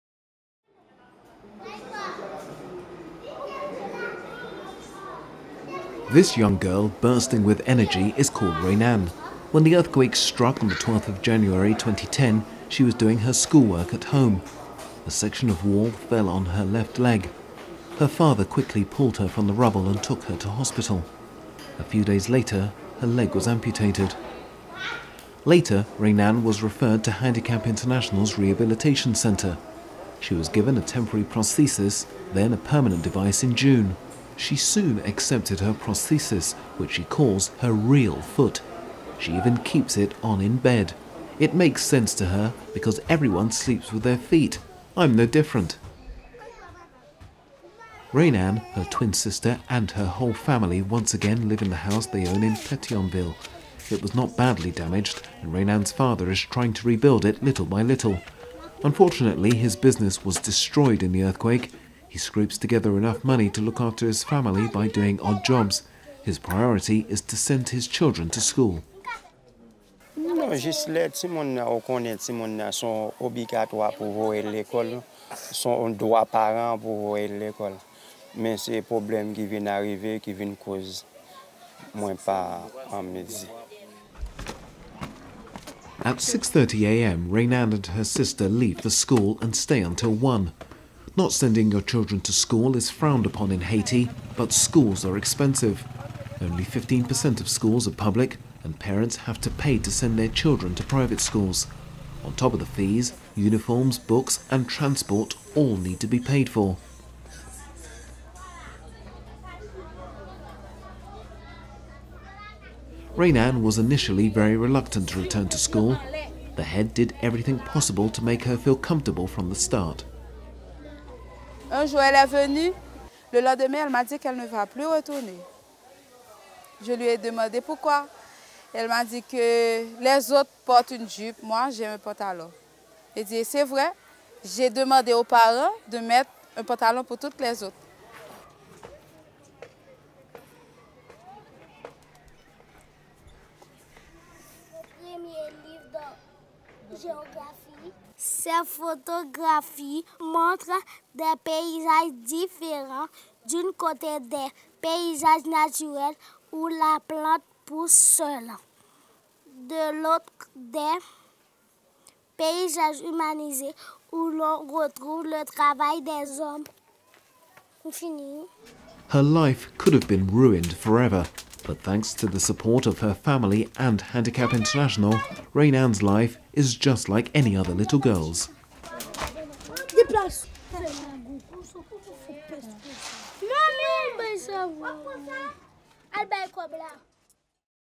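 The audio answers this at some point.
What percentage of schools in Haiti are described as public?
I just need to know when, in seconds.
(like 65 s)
96 s.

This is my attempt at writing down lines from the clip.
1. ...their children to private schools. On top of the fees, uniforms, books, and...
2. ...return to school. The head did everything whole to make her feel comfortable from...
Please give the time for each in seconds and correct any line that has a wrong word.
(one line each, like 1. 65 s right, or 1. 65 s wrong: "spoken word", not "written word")
1. 100 s right
2. 115 s wrong: "possible", not "whole".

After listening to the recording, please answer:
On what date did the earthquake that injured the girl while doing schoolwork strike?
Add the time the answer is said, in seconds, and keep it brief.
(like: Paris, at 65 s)
12 January 2010, at 10 s.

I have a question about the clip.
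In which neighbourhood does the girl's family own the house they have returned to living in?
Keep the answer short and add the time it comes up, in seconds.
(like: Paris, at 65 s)
Petionville, at 52 s.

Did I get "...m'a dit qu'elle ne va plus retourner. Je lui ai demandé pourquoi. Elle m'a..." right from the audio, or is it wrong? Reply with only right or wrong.
right.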